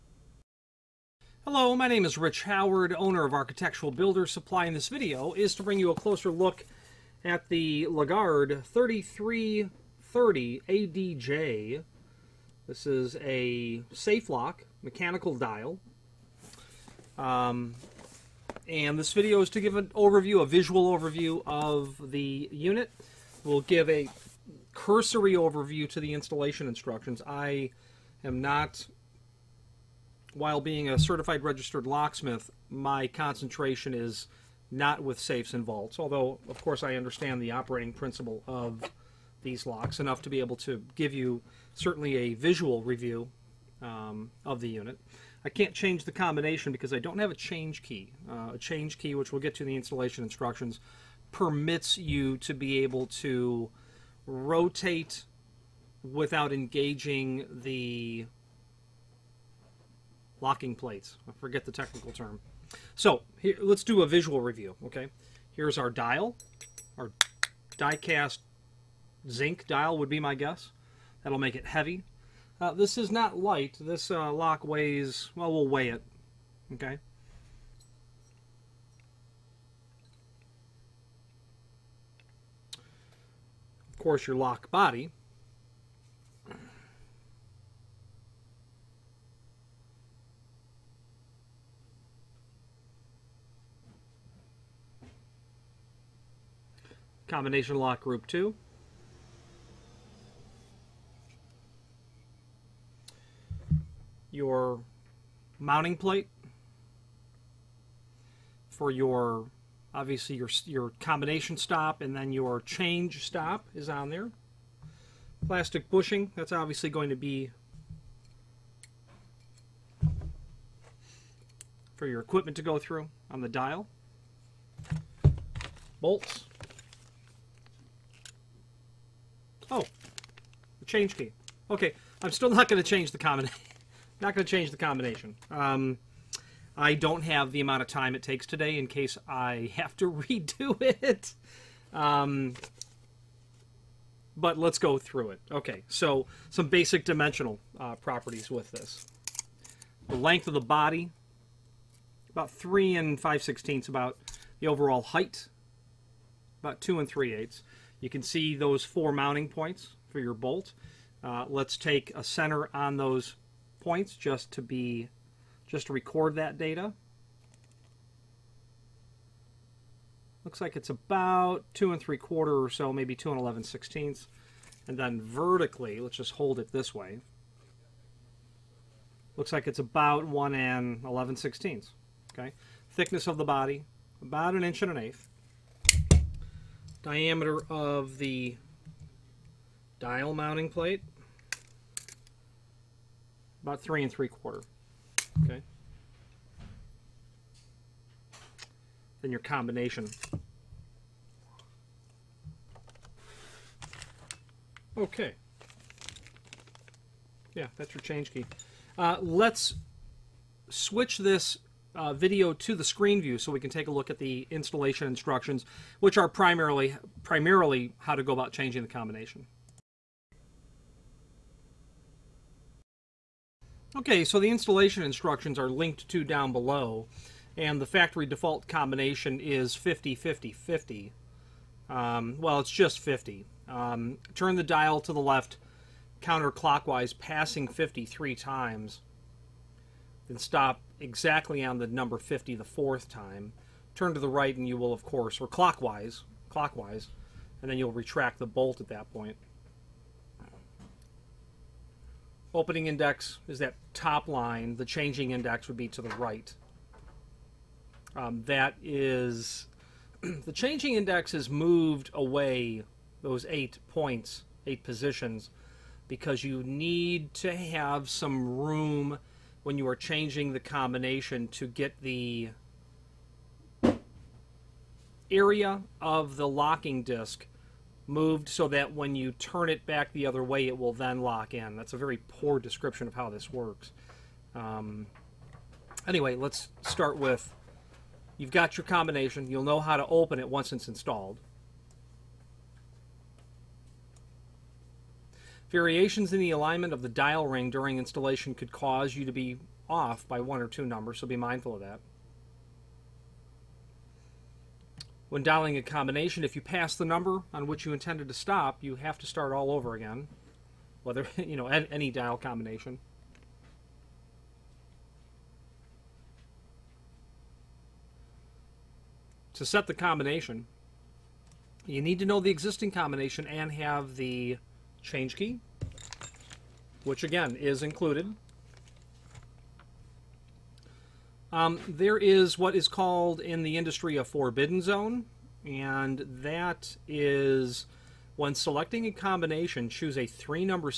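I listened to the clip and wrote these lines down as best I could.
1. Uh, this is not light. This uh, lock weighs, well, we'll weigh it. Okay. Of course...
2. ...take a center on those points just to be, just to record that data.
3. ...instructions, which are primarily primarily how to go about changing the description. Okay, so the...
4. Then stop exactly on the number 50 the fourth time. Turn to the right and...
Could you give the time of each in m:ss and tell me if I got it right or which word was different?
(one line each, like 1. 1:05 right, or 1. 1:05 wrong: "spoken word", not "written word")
1. 1:12 right
2. 2:41 right
3. 3:35 wrong: "combination", not "description"
4. 4:00 right.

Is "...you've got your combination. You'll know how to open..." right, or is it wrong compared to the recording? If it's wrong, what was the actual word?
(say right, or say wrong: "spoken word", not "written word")
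right.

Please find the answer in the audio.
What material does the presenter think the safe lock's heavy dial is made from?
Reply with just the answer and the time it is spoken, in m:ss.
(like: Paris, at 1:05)
die-cast zinc, at 1:07.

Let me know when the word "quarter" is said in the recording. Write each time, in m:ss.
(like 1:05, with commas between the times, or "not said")
2:52, 3:14.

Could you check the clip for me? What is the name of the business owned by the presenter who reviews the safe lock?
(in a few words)
Architectural Builder Supply.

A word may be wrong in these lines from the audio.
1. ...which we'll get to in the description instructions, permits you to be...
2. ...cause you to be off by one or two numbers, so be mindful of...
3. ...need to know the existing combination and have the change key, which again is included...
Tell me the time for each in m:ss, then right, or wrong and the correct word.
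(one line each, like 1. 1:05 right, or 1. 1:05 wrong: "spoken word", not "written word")
1. 0:49 wrong: "installation", not "description"
2. 4:58 right
3. 5:22 right.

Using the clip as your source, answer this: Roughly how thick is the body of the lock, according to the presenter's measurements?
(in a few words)
1 1/8 inches.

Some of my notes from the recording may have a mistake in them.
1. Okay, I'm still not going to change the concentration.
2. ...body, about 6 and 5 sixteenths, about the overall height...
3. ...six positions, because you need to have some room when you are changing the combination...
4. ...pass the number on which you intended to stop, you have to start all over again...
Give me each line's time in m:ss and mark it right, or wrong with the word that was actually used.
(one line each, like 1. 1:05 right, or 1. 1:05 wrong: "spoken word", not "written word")
1. 2:11 wrong: "combination", not "concentration"
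2. 2:30 wrong: "3", not "6"
3. 4:24 wrong: "eight", not "six"
4. 5:06 right.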